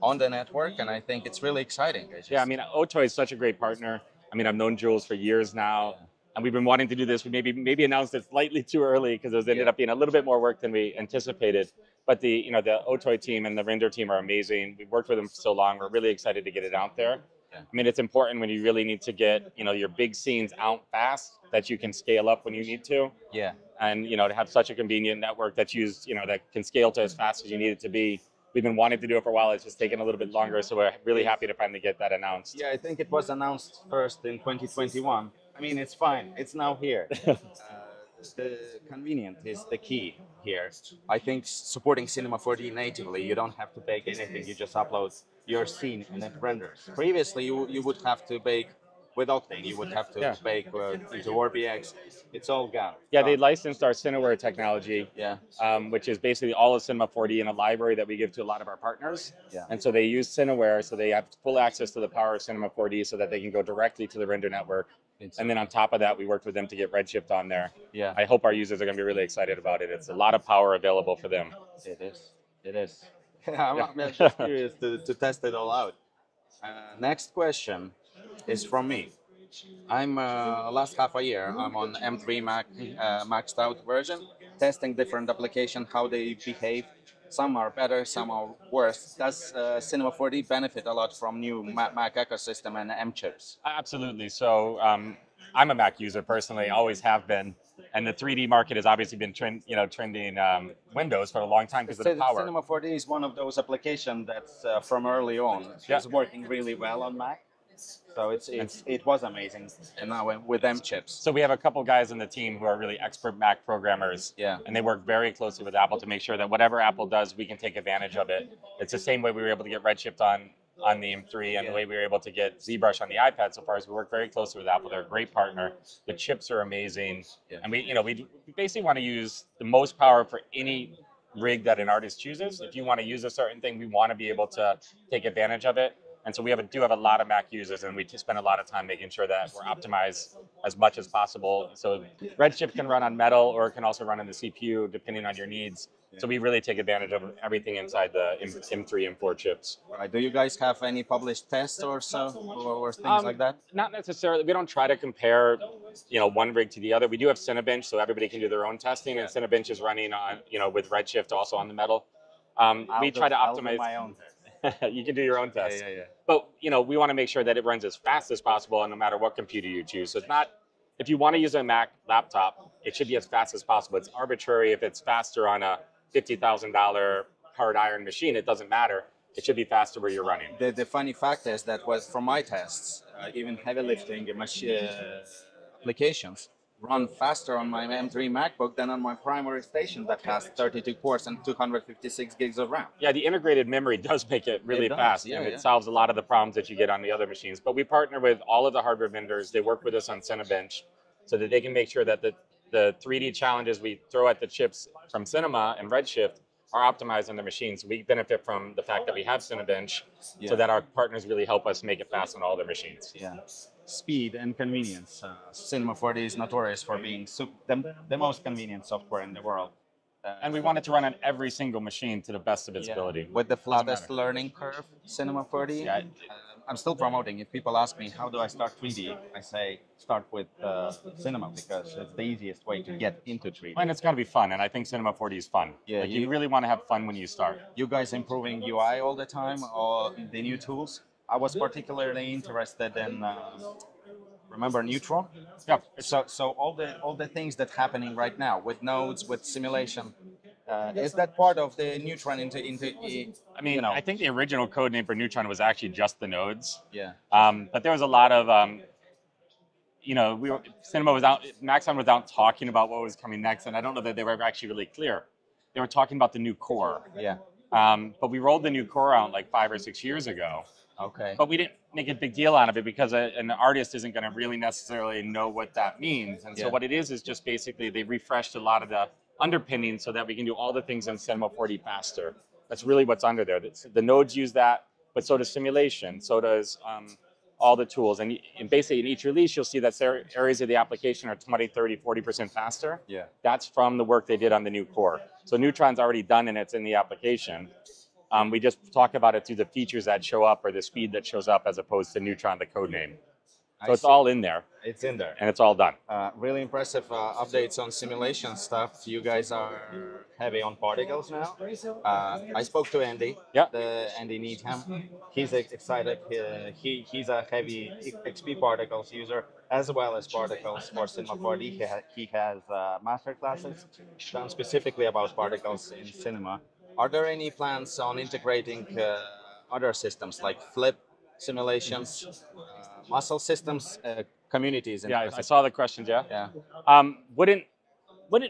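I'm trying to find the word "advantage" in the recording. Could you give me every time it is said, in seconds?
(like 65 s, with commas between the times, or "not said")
117 s, 135 s, 146 s.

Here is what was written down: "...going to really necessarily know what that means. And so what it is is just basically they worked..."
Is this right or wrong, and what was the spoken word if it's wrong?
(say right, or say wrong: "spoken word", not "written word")
wrong: "refreshed", not "worked".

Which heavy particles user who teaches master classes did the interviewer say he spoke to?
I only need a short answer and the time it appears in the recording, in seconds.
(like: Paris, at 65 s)
Andy Needham, at 314 s.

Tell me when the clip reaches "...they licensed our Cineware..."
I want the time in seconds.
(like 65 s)
53 s.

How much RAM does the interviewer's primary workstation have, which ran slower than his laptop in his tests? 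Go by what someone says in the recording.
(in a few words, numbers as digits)
256 GB.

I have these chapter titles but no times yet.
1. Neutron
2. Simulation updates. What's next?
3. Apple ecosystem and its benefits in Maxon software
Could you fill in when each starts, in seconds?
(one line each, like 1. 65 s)
1. 242 s
2. 305 s
3. 79 s.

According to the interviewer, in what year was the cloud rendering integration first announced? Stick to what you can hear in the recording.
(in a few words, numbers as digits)
2021.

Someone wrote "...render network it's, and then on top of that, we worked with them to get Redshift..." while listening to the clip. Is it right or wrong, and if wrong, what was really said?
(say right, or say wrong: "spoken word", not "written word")
right.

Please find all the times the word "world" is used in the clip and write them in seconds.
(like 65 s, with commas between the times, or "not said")
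219 s.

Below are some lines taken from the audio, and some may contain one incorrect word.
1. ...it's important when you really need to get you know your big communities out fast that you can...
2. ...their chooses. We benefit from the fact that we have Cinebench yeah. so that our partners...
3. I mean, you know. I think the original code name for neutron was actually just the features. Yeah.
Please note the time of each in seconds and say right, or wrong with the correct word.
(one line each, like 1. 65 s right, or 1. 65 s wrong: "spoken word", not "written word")
1. 17 s wrong: "scenes", not "communities"
2. 207 s wrong: "machines", not "chooses"
3. 253 s wrong: "nodes", not "features".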